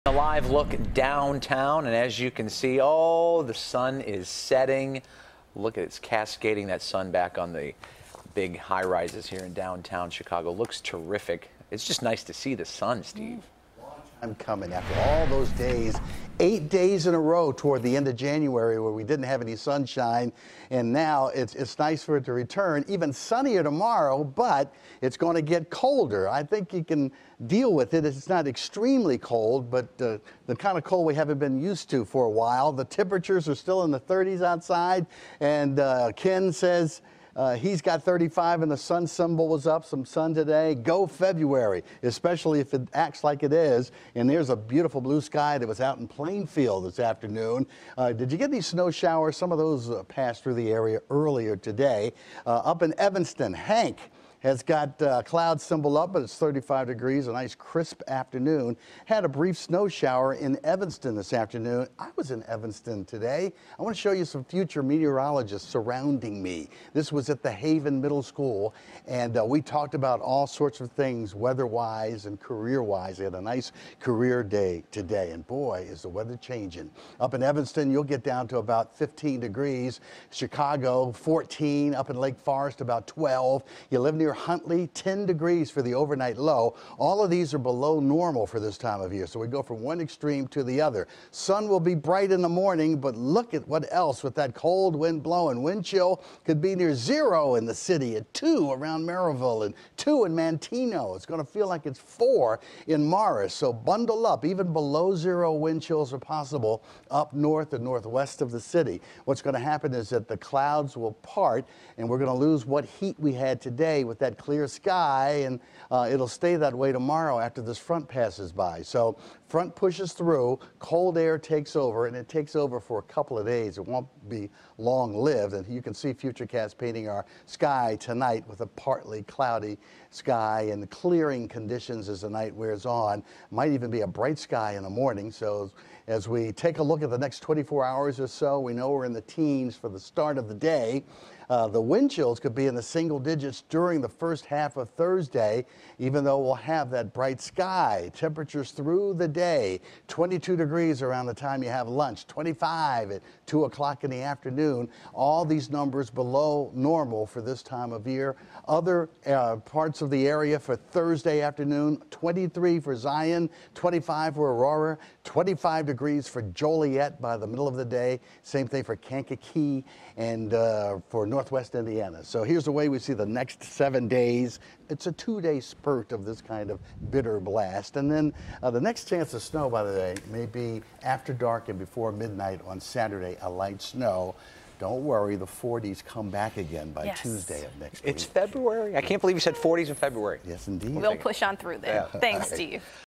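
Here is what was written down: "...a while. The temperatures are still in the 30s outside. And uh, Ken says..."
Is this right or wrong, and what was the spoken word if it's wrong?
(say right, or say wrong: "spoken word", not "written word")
right.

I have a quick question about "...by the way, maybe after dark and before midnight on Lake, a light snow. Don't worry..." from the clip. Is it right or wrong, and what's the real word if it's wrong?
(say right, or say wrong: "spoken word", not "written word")
wrong: "Saturday", not "Lake".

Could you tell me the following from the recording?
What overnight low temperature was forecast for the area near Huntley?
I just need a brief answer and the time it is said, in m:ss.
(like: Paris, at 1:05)
10 degrees, at 1:24.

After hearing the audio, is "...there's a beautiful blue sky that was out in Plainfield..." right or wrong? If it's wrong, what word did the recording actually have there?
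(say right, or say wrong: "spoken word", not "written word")
right.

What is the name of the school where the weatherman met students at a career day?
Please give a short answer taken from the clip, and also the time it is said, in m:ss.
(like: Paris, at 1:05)
Haven Middle School, at 1:07.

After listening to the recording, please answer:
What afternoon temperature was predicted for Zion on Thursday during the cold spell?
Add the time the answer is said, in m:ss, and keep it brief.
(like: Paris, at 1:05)
23, at 2:42.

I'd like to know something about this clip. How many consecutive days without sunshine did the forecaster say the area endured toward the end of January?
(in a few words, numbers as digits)
8.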